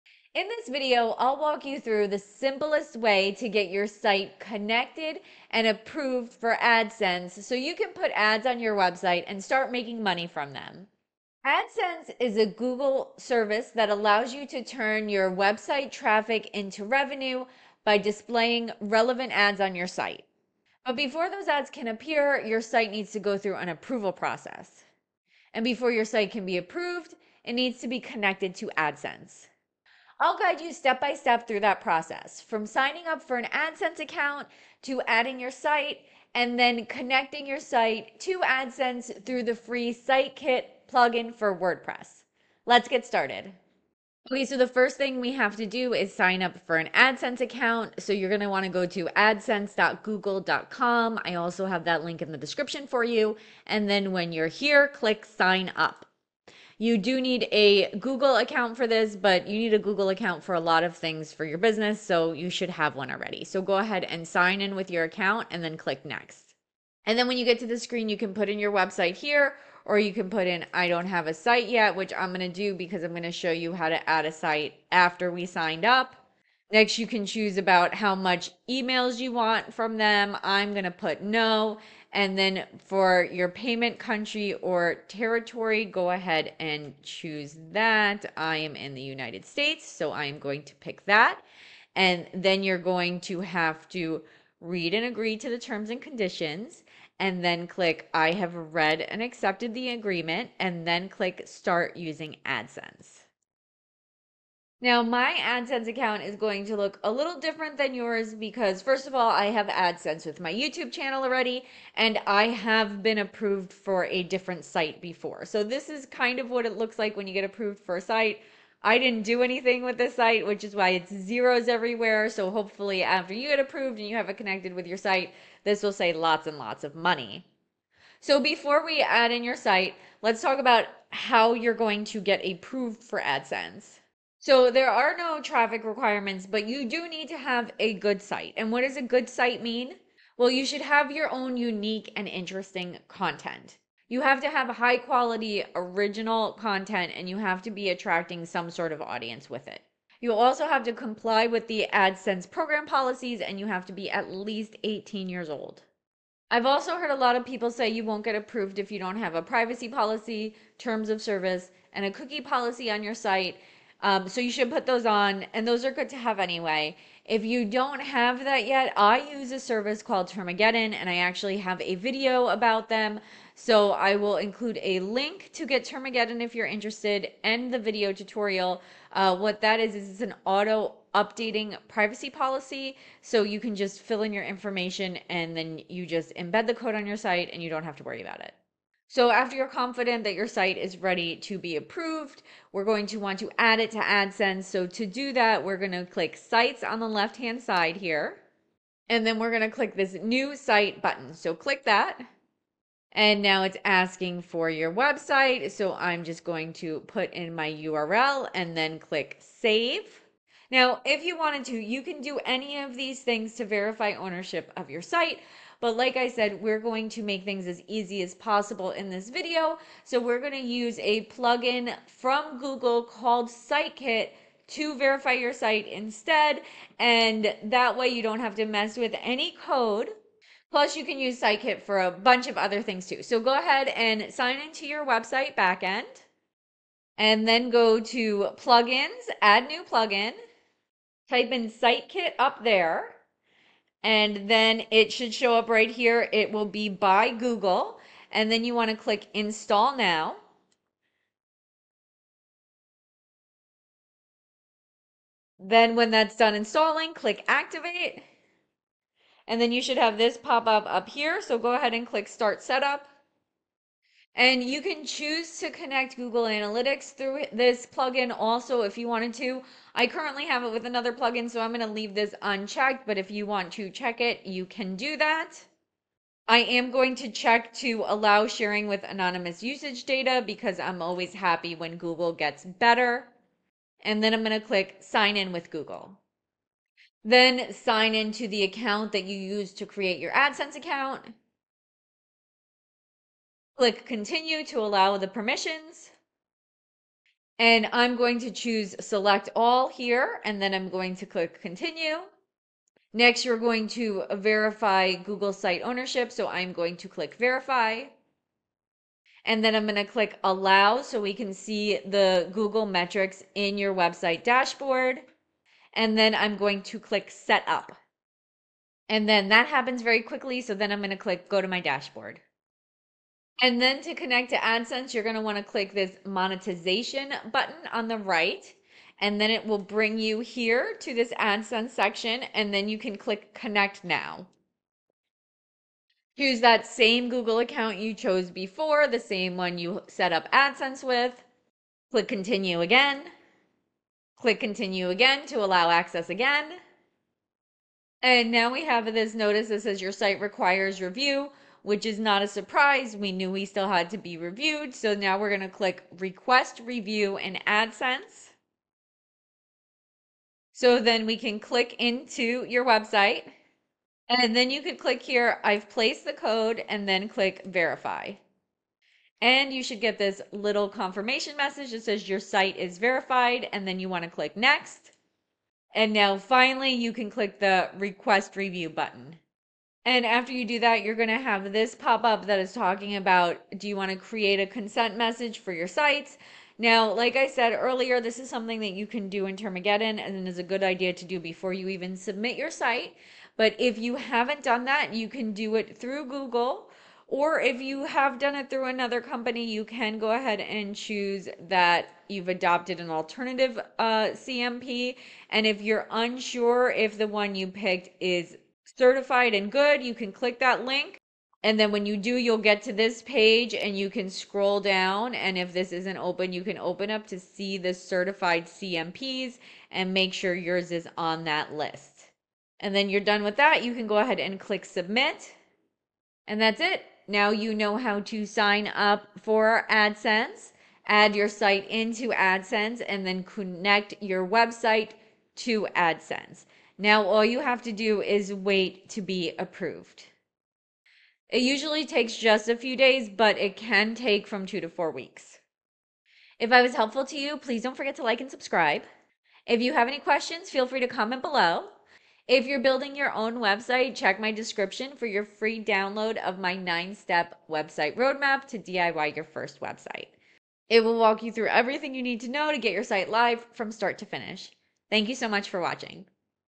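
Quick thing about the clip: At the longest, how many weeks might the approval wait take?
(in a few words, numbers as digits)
4.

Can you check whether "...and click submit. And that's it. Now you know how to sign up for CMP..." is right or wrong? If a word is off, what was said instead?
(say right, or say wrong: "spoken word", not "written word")
wrong: "AdSense", not "CMP".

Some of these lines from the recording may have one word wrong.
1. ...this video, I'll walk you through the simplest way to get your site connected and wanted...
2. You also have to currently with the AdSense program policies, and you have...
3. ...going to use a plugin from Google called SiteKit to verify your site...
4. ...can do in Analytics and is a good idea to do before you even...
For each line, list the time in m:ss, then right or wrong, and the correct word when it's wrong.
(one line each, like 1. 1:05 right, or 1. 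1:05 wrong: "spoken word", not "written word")
1. 0:00 wrong: "approved", not "wanted"
2. 2:30 wrong: "comply", not "currently"
3. 3:40 right
4. 6:29 wrong: "Termageddon", not "Analytics".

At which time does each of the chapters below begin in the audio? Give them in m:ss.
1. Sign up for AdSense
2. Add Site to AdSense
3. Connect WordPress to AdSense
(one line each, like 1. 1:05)
1. 0:44
2. 3:09
3. 3:56.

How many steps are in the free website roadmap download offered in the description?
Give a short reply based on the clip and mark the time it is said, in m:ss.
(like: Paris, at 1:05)
9, at 7:36.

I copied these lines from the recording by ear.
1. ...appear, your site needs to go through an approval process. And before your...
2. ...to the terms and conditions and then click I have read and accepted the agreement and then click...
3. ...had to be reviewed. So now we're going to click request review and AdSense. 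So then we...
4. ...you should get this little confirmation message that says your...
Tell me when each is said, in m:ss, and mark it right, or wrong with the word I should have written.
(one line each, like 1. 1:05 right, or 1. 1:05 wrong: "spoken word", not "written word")
1. 0:21 right
2. 1:35 right
3. 5:53 right
4. 6:09 right.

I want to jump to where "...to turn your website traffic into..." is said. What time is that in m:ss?
0:14.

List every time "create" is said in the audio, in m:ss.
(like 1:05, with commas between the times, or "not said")
4:49, 6:24.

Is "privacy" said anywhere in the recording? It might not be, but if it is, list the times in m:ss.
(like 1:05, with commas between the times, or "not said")
2:39, 3:01.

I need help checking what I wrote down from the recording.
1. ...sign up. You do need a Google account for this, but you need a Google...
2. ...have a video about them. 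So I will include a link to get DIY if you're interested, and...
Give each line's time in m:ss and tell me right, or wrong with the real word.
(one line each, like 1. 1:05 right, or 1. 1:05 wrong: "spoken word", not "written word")
1. 0:55 right
2. 2:51 wrong: "Termageddon", not "DIY".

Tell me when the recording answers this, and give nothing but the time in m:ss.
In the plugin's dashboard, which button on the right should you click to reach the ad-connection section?
5:26.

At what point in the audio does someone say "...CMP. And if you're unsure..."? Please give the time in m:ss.
6:44.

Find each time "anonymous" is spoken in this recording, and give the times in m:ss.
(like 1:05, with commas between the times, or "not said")
4:39.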